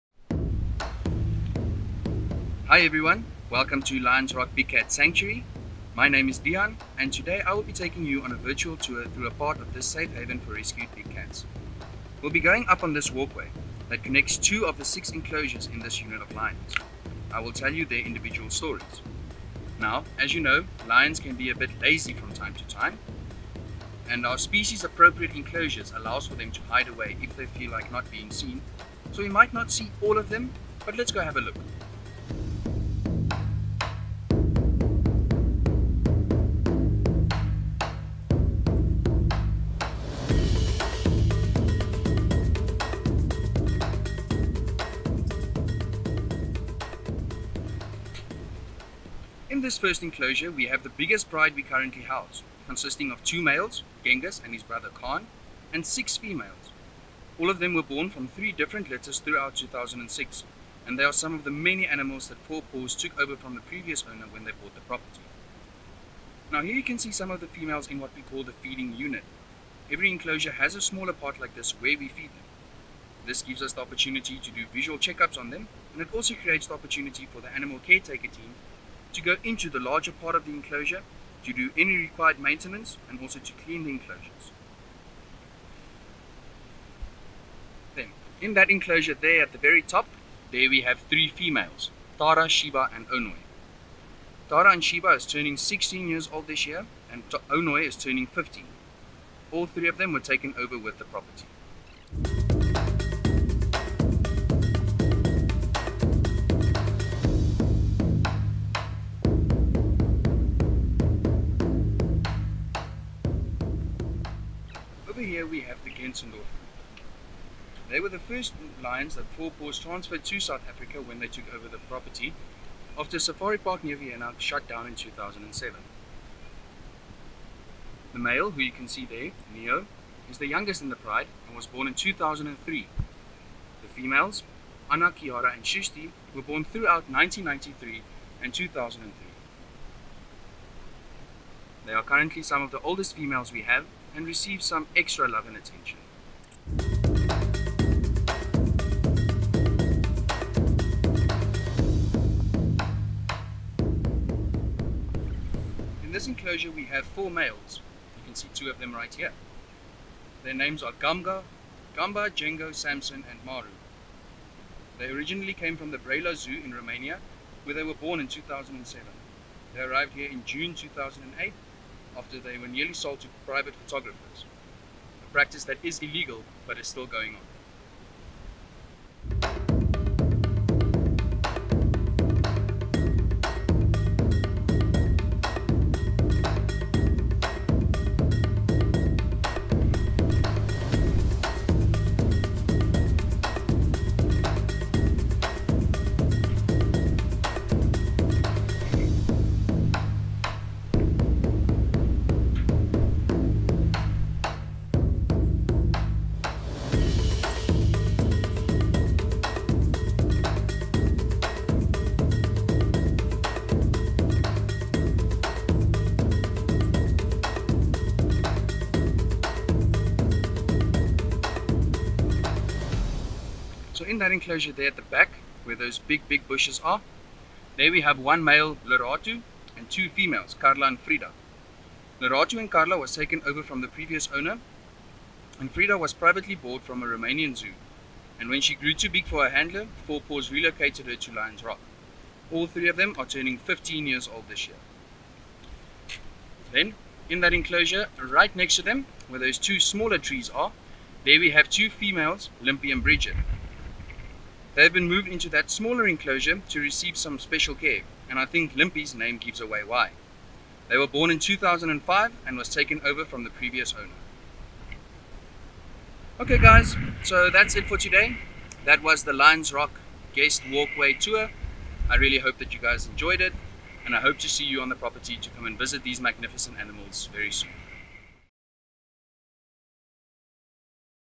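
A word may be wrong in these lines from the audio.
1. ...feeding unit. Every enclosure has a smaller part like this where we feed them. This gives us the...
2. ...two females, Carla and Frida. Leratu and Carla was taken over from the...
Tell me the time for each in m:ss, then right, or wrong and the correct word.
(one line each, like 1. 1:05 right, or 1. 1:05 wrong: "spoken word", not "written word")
1. 1:08 right
2. 3:49 right.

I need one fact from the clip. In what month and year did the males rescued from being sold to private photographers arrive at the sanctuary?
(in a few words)
June 2008.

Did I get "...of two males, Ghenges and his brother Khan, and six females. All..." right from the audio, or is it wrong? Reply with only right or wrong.
right.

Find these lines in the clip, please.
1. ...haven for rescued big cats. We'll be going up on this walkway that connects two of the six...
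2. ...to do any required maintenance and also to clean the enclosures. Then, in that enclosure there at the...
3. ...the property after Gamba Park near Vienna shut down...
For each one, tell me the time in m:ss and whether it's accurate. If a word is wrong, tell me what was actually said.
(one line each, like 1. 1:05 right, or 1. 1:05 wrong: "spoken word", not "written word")
1. 0:10 right
2. 1:21 right
3. 2:01 wrong: "Safari", not "Gamba".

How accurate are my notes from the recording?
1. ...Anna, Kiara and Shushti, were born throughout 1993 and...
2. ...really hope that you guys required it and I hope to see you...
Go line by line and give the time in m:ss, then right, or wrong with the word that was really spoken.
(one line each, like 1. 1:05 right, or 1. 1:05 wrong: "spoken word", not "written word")
1. 2:14 right
2. 4:32 wrong: "enjoyed", not "required".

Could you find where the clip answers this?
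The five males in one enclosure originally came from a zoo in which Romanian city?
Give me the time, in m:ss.
2:45.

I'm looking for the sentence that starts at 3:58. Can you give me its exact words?
And when she grew too big for her handler, Four Paws relocated her to Lions Rock.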